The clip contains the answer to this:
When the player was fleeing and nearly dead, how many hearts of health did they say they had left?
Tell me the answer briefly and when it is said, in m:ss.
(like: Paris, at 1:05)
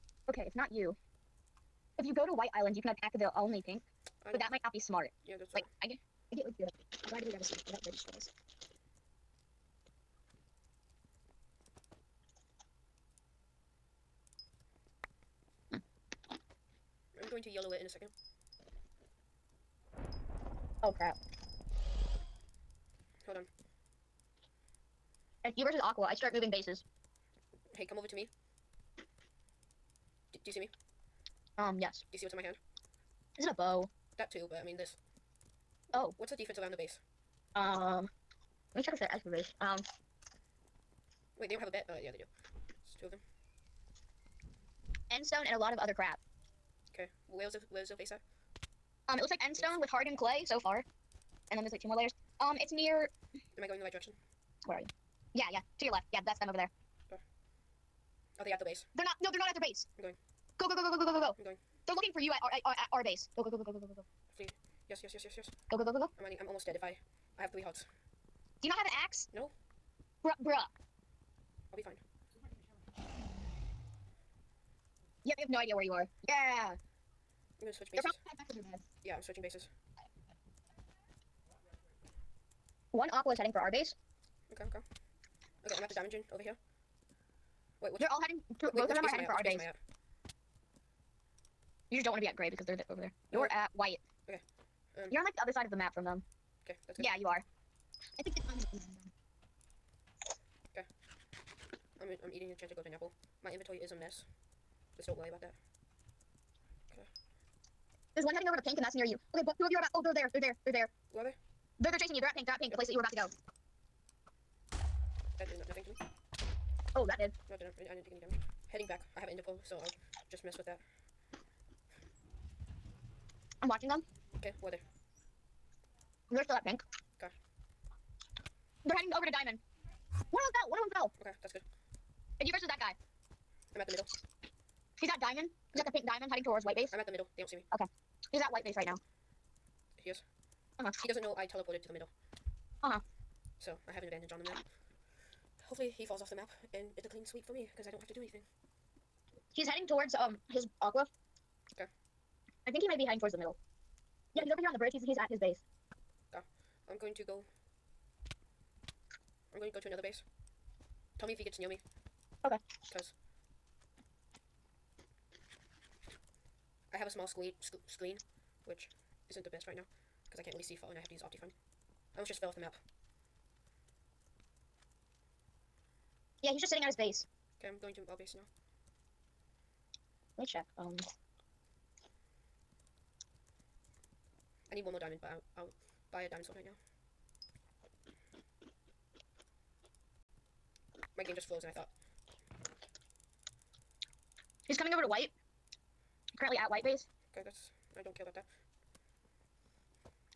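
3, at 1:07.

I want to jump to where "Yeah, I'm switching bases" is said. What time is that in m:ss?
1:19.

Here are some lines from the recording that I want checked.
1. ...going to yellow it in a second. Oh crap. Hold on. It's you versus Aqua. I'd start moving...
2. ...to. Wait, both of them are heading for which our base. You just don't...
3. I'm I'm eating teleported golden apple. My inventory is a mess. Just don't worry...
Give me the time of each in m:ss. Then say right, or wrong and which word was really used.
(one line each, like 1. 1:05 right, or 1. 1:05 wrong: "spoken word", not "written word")
1. 0:17 right
2. 1:28 right
3. 1:42 wrong: "enchanted", not "teleported".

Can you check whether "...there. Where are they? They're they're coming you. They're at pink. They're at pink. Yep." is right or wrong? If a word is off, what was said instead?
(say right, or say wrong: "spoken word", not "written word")
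wrong: "chasing", not "coming".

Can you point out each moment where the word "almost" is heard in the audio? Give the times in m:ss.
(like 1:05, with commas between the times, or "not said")
1:06, 2:52.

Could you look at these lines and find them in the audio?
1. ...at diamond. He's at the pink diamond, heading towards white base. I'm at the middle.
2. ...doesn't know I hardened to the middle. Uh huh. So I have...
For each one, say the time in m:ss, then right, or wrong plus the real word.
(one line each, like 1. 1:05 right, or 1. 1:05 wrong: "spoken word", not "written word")
1. 2:15 right
2. 2:21 wrong: "teleported", not "hardened".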